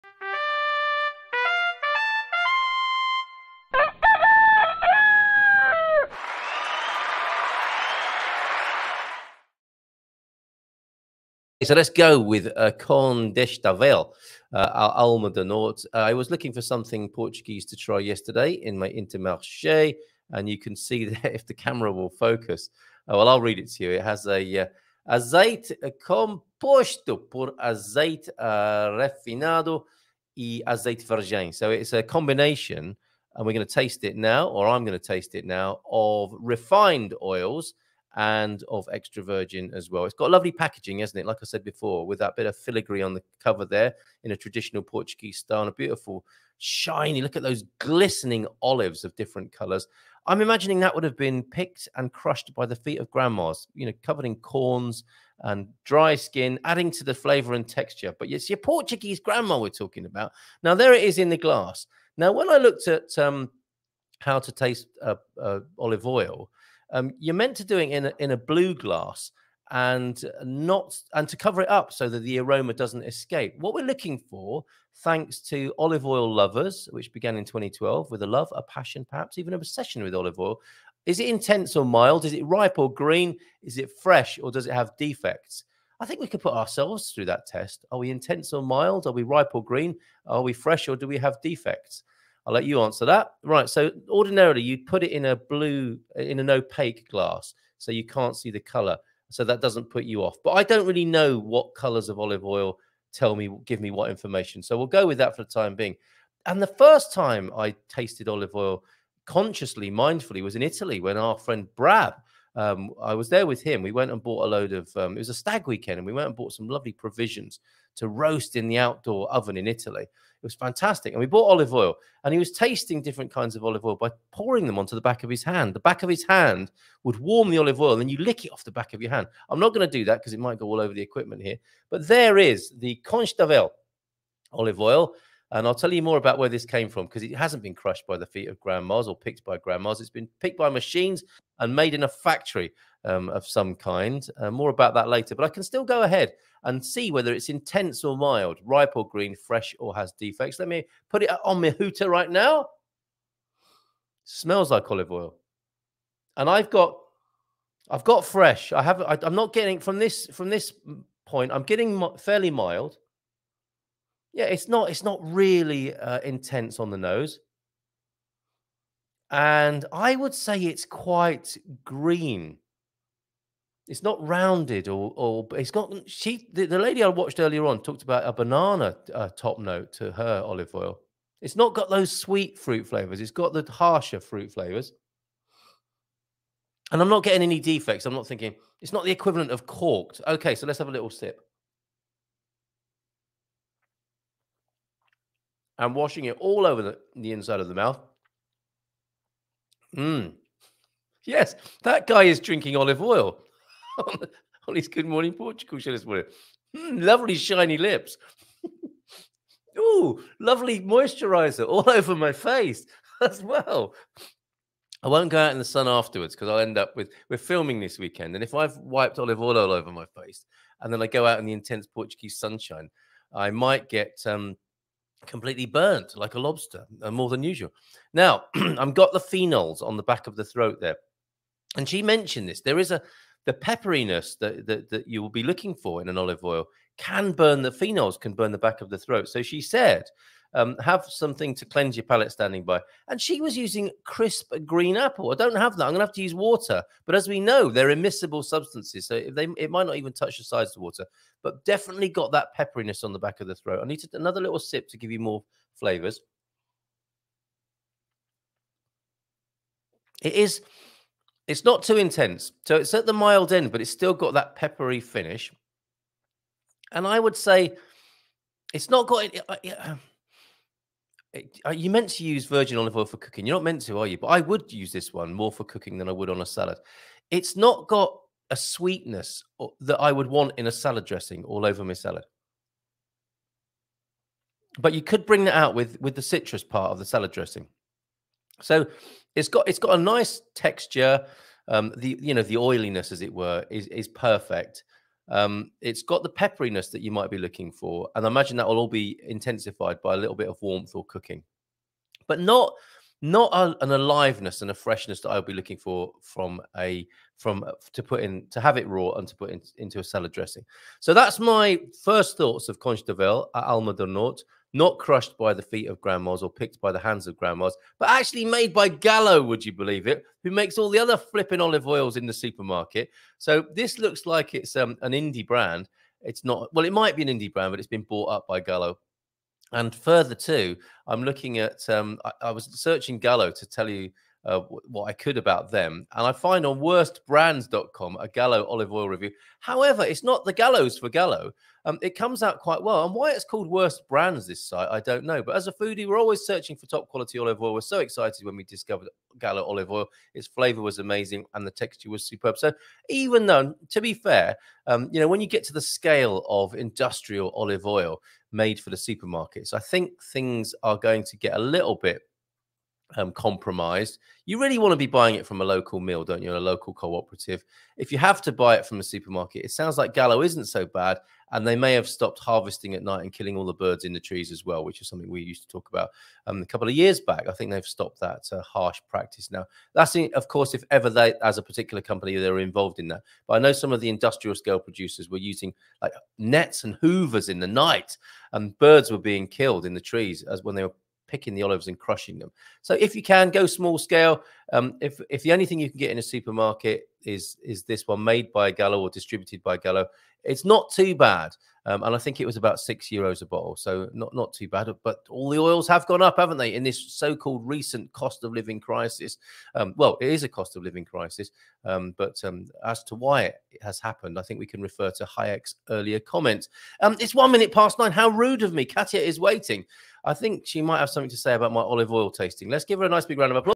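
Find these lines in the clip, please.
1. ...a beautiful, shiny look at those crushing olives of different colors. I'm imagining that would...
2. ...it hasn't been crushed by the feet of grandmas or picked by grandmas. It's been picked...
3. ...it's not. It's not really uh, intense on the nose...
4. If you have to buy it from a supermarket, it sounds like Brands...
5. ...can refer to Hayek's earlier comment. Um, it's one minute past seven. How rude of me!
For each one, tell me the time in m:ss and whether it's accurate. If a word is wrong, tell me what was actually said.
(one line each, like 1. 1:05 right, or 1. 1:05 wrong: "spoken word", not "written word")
1. 0:45 wrong: "glistening", not "crushing"
2. 2:17 right
3. 2:44 right
4. 6:07 wrong: "Gallo", not "Brands"
5. 6:54 wrong: "nine", not "seven".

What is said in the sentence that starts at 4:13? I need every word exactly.
I need to, another little sip to give you more flavors.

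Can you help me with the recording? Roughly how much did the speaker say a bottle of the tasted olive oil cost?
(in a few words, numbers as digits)
6 euros.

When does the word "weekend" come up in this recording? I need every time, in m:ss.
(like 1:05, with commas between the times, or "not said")
1:55, 3:37.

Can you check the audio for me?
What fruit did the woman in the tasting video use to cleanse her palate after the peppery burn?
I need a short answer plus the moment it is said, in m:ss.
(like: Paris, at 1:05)
Crisp green apple, at 4:04.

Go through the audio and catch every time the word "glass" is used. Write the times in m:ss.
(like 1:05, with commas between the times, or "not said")
1:01, 1:08, 1:37.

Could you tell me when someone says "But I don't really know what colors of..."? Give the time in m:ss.
1:40.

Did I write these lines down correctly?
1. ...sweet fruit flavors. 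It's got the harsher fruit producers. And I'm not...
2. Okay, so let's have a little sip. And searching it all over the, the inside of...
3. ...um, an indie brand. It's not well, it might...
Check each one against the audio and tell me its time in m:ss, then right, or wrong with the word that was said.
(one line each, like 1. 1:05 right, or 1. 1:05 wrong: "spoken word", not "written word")
1. 3:02 wrong: "flavors", not "producers"
2. 3:10 wrong: "washing", not "searching"
3. 5:24 right.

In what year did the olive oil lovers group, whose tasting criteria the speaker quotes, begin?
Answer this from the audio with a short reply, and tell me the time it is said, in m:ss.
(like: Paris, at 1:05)
2012, at 1:17.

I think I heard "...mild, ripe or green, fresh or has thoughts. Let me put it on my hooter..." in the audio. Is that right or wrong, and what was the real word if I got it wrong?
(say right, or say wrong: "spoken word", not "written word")
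wrong: "defects", not "thoughts".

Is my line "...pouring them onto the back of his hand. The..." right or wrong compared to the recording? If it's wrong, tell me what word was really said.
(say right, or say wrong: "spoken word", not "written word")
right.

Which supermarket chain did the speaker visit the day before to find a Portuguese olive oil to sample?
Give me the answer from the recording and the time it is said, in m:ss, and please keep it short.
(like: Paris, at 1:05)
Intermarché, at 0:18.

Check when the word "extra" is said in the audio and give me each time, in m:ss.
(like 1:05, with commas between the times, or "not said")
0:38.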